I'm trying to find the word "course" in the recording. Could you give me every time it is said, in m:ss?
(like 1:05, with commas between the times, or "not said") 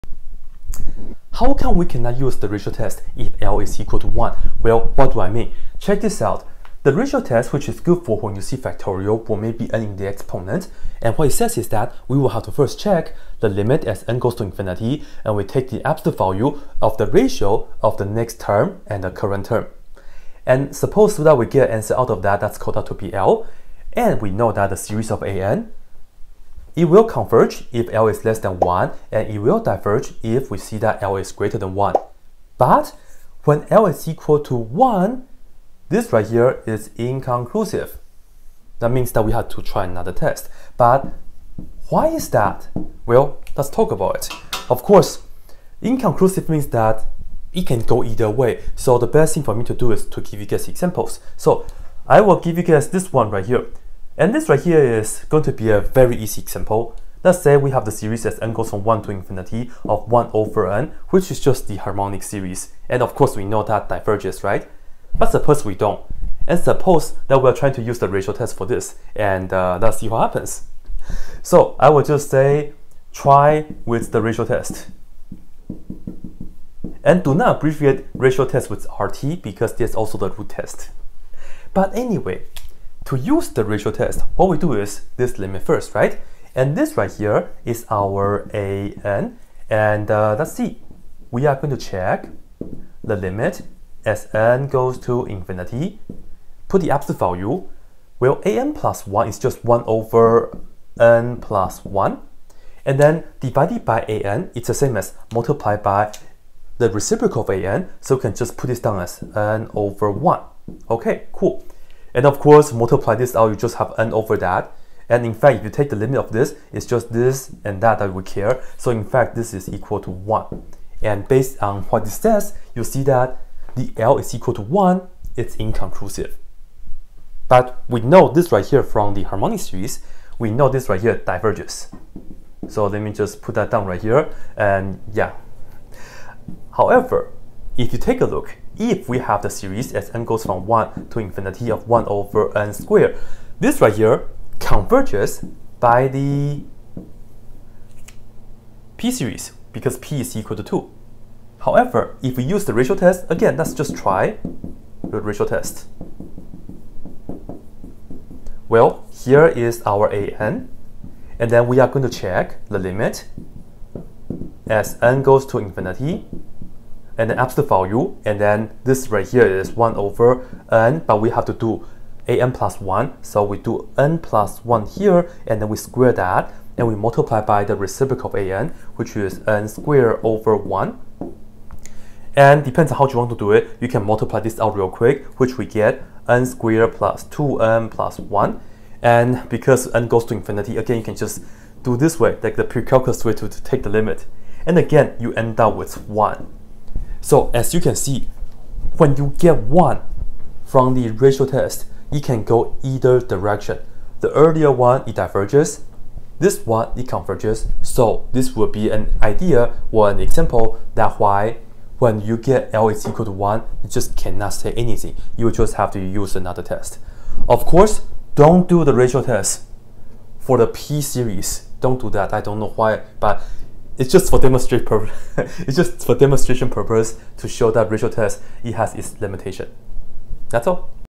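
0:44, 1:03, 1:52, 3:37.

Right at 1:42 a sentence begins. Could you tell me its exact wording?
And then divided by an, it's the same as multiplied by the reciprocal of an.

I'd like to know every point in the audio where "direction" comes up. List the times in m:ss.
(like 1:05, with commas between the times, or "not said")
3:23.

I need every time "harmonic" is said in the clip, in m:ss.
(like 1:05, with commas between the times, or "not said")
1:01, 2:09.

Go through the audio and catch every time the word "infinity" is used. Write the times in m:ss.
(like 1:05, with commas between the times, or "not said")
0:14, 0:59, 1:35, 2:21, 2:45, 3:10.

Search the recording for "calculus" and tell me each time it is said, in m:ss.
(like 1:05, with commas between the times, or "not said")
3:12.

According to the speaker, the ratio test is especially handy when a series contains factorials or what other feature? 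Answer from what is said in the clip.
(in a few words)
n in the exponent.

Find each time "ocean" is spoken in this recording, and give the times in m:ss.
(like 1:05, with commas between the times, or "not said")
not said.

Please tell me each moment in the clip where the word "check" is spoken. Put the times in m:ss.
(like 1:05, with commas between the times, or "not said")
0:05, 0:12, 1:31, 2:42.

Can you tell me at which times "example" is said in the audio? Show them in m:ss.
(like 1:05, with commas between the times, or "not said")
0:50, 0:56, 3:30.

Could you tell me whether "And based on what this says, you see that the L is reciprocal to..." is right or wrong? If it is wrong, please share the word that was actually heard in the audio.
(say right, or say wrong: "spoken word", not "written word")
wrong: "equal", not "reciprocal".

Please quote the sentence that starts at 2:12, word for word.
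So let me just put that down right here.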